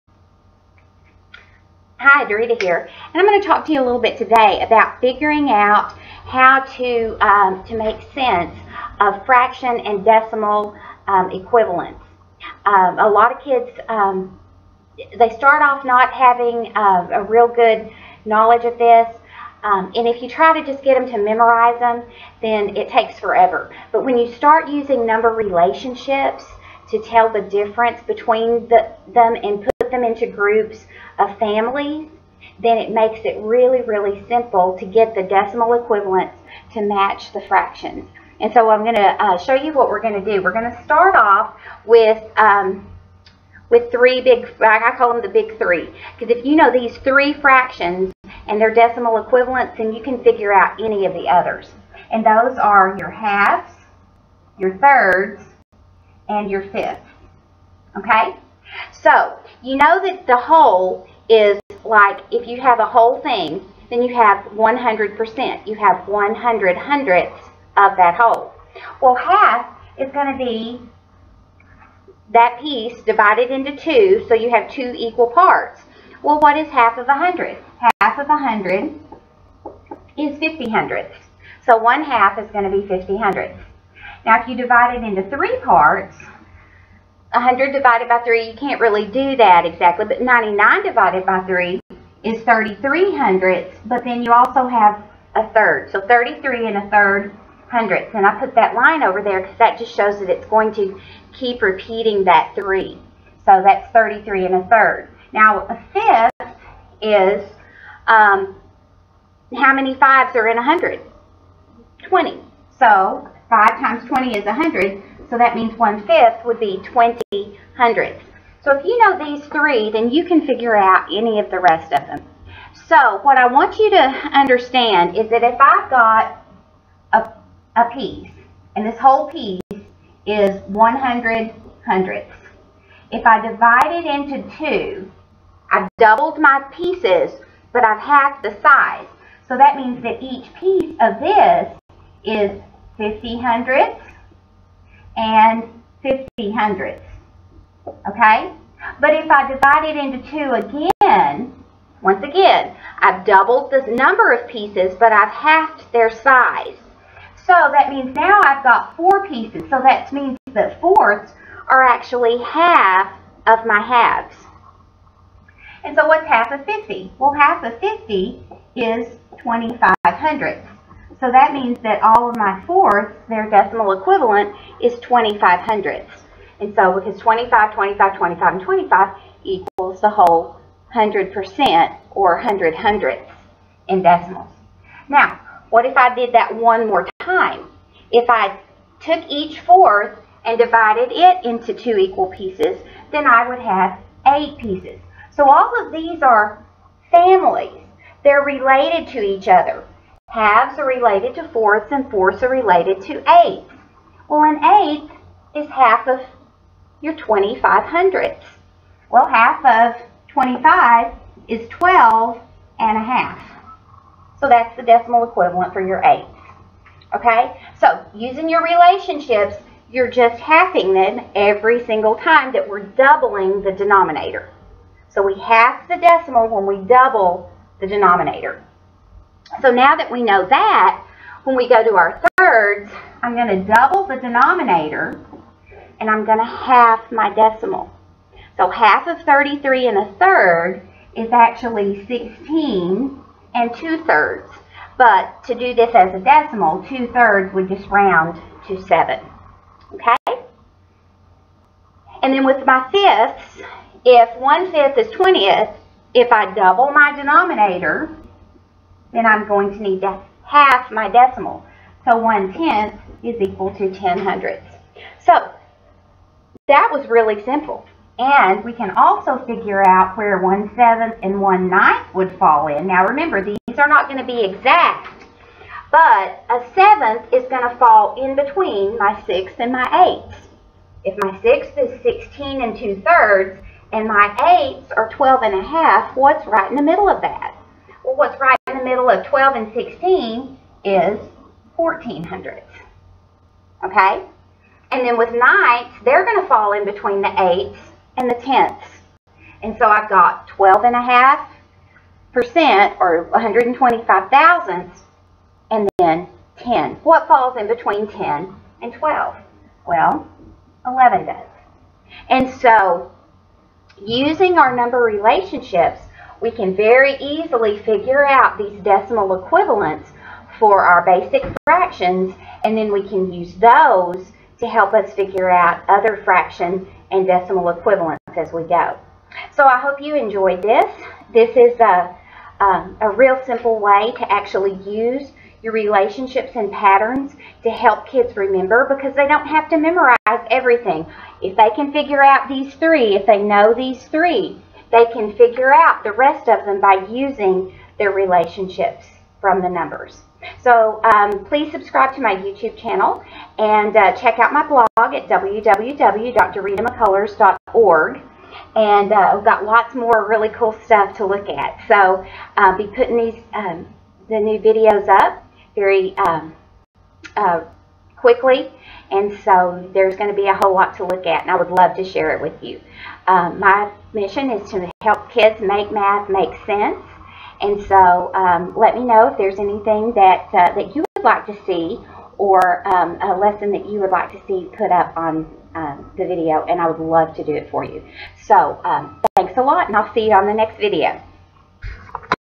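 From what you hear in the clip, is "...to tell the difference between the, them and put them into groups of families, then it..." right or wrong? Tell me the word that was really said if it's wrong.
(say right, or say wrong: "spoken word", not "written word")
right.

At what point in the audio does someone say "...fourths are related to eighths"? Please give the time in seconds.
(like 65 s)
202 s.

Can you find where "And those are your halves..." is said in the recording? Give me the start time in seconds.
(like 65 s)
52 s.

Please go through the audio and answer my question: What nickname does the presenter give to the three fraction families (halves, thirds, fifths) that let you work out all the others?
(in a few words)
the big three.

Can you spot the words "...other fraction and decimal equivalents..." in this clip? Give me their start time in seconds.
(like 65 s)
325 s.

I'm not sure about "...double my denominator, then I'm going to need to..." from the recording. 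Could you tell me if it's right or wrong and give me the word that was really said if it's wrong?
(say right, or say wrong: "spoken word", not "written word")
right.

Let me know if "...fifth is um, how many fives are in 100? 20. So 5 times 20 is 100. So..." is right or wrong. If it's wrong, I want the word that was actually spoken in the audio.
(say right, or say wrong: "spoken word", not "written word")
right.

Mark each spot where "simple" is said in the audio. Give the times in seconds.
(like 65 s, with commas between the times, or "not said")
34 s, 267 s, 333 s.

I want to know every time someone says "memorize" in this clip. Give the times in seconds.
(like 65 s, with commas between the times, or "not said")
21 s, 339 s.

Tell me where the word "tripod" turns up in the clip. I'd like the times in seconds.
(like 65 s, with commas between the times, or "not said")
not said.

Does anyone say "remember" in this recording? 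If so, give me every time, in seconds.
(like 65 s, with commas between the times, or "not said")
273 s, 338 s.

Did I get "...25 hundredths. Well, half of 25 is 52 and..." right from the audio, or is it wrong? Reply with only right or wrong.
wrong.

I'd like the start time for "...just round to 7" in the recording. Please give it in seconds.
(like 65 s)
247 s.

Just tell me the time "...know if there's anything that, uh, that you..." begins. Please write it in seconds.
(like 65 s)
379 s.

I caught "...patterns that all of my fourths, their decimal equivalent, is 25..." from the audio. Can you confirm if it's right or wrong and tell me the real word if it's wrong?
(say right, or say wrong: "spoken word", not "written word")
wrong: "means", not "patterns".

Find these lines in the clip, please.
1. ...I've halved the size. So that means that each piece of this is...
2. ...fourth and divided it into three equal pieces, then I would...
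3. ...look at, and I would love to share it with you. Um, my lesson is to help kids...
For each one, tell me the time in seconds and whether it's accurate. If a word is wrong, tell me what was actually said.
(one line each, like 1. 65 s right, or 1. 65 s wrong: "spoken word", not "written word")
1. 137 s right
2. 189 s wrong: "two", not "three"
3. 371 s wrong: "mission", not "lesson".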